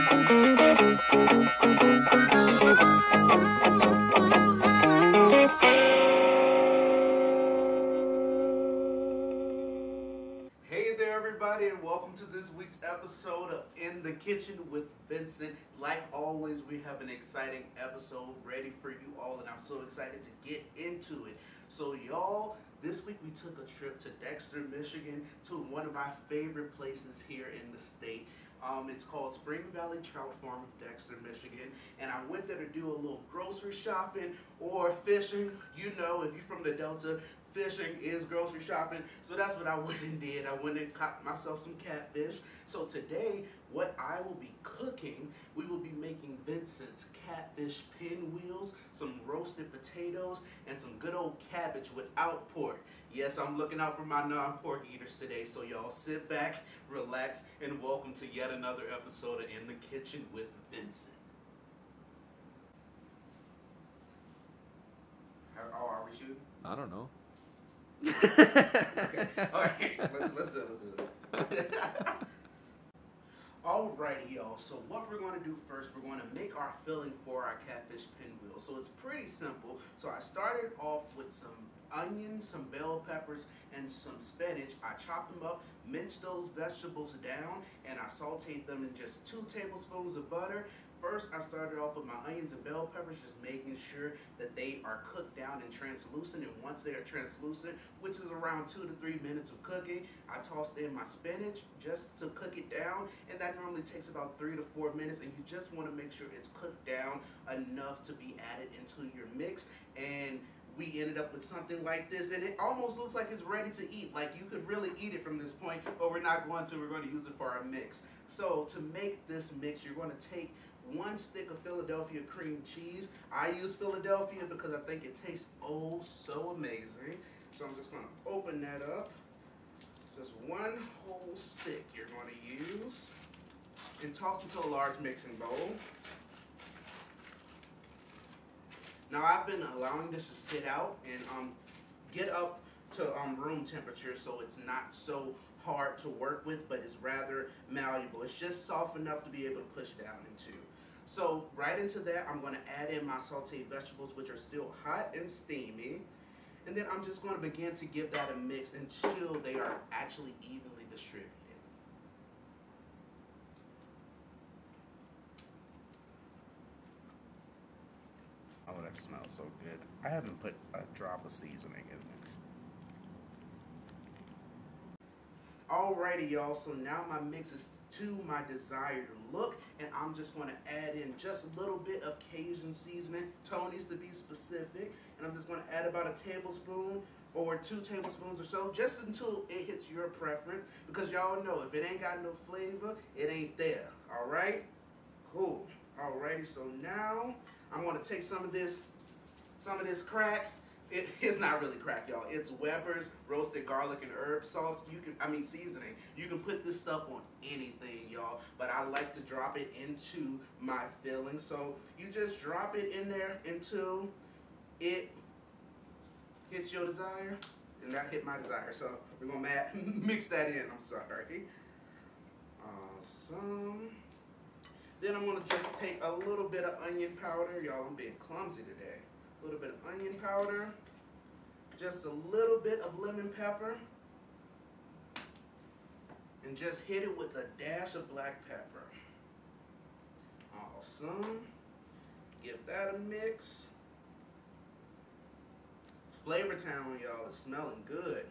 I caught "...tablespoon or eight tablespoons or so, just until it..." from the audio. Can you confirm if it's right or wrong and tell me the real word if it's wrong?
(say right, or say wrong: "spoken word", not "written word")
wrong: "two", not "eight".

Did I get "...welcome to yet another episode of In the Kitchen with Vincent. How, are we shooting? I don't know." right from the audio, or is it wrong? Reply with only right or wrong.
right.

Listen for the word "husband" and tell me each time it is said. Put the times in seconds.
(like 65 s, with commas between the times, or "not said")
not said.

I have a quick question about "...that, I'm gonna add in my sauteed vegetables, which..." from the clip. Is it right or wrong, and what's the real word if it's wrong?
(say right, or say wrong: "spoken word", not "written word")
right.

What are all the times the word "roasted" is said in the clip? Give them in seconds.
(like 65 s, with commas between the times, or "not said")
49 s, 203 s.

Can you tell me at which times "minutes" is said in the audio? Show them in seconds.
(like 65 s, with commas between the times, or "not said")
99 s, 104 s.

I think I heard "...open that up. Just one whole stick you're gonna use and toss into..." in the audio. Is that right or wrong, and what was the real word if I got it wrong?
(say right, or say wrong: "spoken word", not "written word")
right.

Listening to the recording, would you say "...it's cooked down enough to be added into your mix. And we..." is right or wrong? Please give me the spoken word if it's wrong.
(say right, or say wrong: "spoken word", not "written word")
right.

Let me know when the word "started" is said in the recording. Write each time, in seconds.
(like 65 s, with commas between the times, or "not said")
80 s, 91 s.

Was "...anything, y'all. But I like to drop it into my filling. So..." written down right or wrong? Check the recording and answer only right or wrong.
right.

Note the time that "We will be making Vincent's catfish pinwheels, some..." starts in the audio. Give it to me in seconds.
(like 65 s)
45 s.